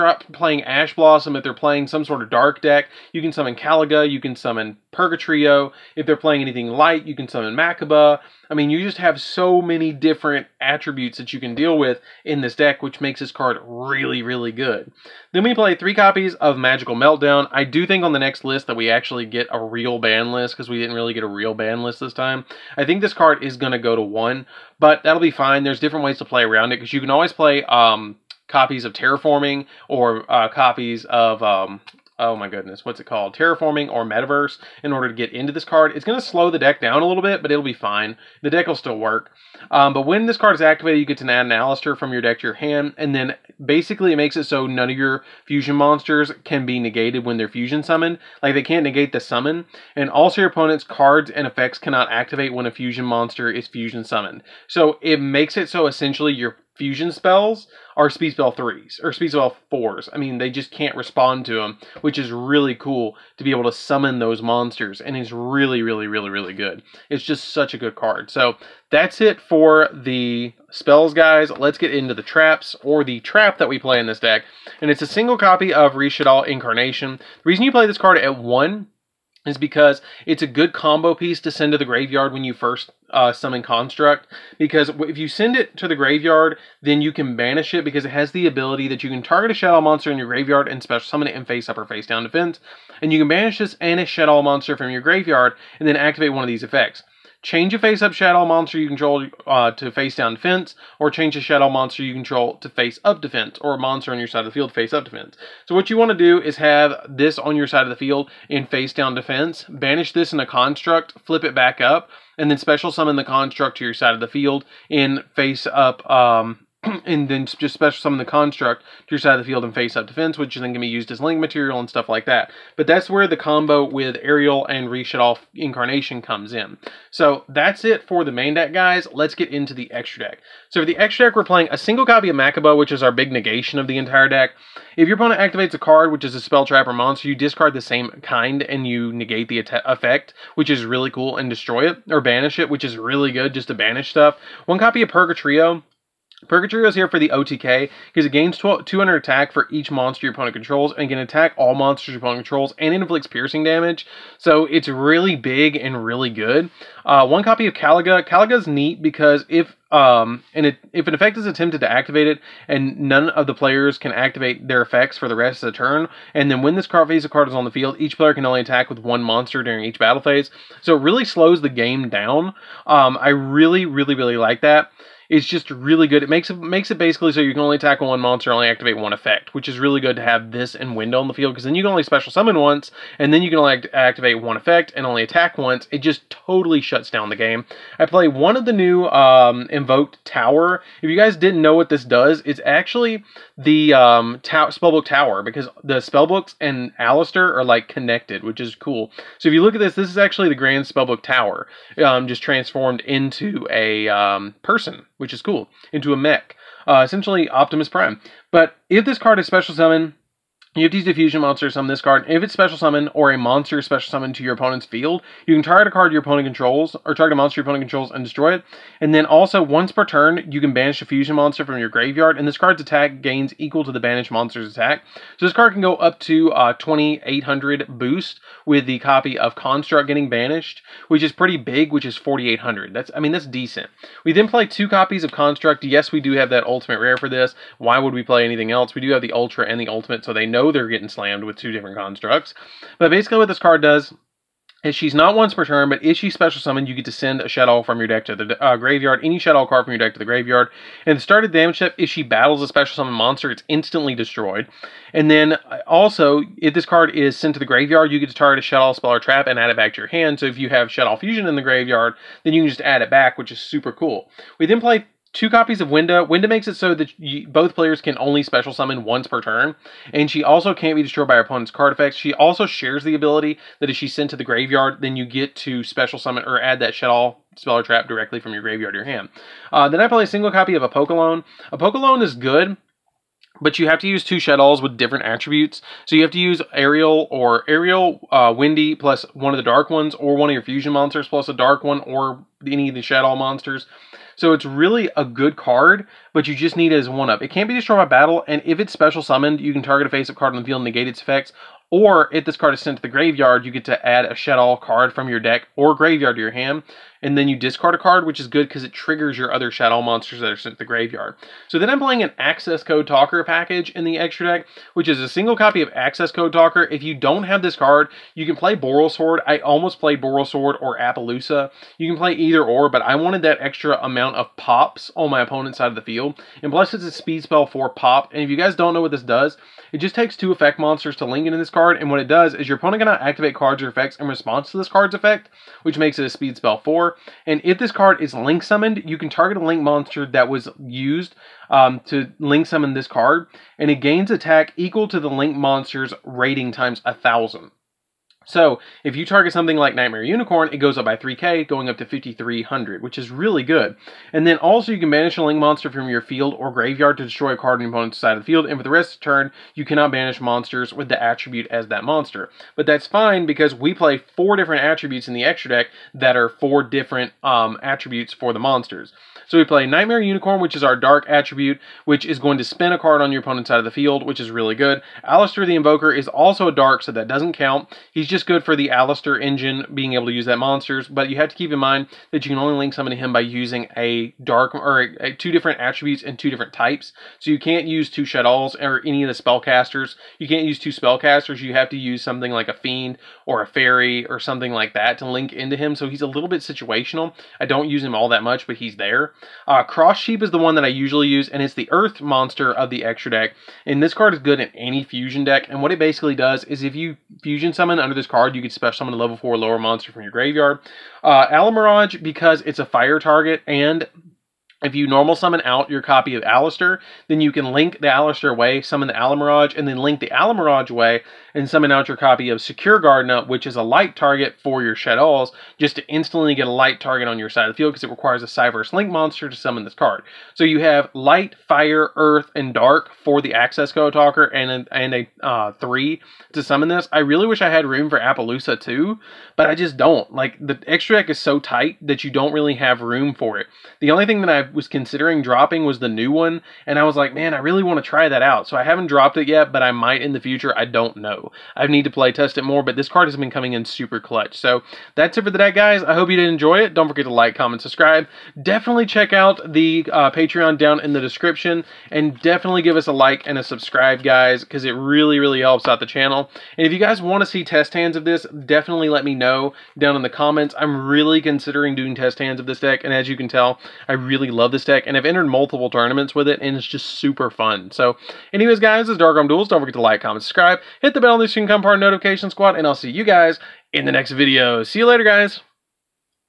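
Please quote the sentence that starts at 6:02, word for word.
But that's fine because we play four different attributes in the extra deck that are four different um, attributes for the monsters.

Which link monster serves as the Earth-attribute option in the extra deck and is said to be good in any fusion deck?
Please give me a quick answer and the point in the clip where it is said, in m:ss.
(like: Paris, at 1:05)
Cross Sheep, at 6:39.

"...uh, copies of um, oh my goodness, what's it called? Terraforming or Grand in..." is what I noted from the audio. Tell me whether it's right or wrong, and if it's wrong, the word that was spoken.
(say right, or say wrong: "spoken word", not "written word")
wrong: "Metaverse", not "Grand".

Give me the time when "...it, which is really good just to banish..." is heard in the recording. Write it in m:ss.
2:22.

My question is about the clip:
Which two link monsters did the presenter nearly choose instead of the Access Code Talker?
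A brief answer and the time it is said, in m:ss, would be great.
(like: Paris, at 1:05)
Borrelsword or Apollousa, at 5:20.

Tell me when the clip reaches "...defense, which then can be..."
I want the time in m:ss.
2:00.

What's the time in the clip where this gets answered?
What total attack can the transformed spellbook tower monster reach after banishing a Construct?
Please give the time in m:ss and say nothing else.
3:52.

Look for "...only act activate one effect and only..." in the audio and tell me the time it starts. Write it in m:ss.
3:03.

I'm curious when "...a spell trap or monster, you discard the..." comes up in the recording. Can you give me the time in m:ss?
2:16.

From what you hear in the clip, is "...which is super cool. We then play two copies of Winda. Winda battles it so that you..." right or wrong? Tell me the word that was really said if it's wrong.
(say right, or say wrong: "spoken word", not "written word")
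wrong: "makes", not "battles".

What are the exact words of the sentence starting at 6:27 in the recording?
So you can't use two Shaddolls or any of the spellcasters.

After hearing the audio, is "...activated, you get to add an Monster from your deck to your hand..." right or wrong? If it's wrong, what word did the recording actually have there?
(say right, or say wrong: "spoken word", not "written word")
wrong: "Aleister", not "Monster".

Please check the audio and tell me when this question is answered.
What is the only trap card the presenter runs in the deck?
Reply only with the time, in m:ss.
1:15.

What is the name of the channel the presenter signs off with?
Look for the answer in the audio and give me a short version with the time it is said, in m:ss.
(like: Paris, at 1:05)
Dark Arm Duels, at 7:59.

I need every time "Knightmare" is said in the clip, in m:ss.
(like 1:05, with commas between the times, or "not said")
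5:49, 6:09.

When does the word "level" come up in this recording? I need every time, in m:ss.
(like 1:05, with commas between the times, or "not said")
6:49.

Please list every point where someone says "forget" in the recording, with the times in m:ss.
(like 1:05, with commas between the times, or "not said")
7:37, 7:59.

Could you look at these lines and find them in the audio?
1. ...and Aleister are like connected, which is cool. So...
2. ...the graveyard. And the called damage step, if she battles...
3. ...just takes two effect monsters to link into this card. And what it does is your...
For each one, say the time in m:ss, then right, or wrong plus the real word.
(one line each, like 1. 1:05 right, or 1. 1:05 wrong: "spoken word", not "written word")
1. 3:16 right
2. 4:10 wrong: "started", not "called"
3. 5:29 right.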